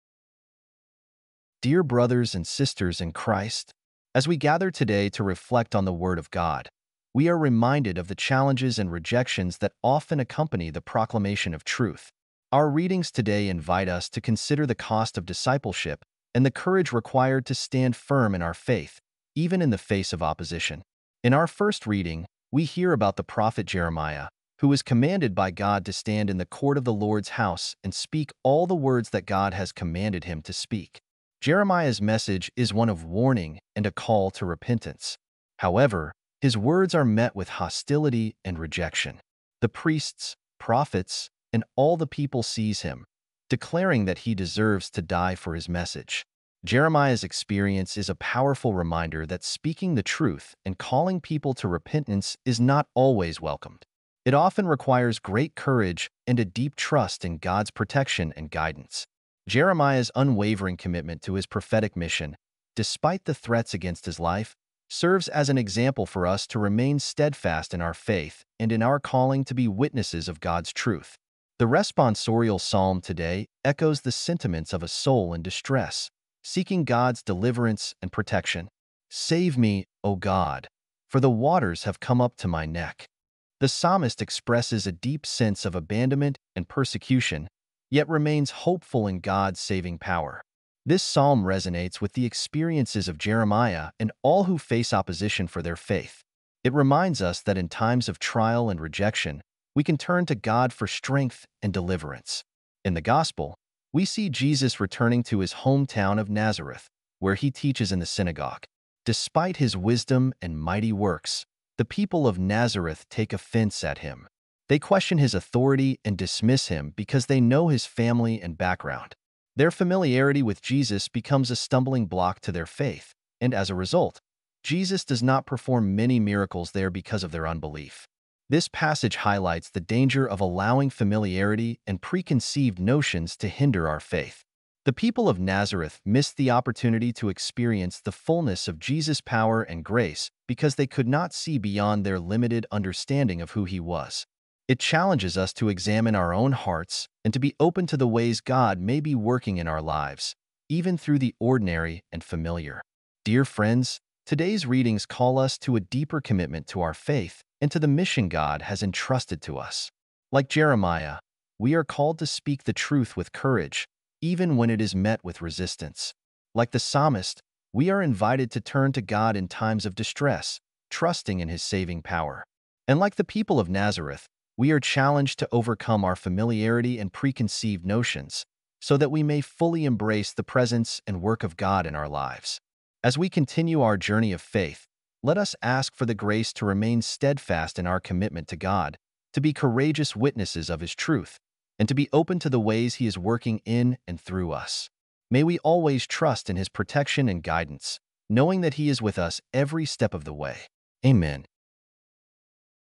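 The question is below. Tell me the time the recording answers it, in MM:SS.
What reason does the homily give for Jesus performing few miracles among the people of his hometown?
02:07.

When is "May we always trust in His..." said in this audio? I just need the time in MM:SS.
03:15.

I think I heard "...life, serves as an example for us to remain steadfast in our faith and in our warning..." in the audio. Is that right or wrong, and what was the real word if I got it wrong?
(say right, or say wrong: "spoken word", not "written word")
wrong: "calling", not "warning".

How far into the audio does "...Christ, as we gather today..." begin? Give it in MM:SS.
00:03.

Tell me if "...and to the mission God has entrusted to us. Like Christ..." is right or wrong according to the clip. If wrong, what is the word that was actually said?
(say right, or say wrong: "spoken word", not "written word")
wrong: "Jeremiah", not "Christ".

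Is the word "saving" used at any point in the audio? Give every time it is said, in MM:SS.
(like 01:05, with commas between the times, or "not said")
01:29, 02:51.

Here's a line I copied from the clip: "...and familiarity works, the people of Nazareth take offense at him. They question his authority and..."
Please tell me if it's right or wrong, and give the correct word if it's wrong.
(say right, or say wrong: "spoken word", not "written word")
wrong: "mighty", not "familiarity".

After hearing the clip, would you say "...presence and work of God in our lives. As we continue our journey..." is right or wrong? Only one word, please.
right.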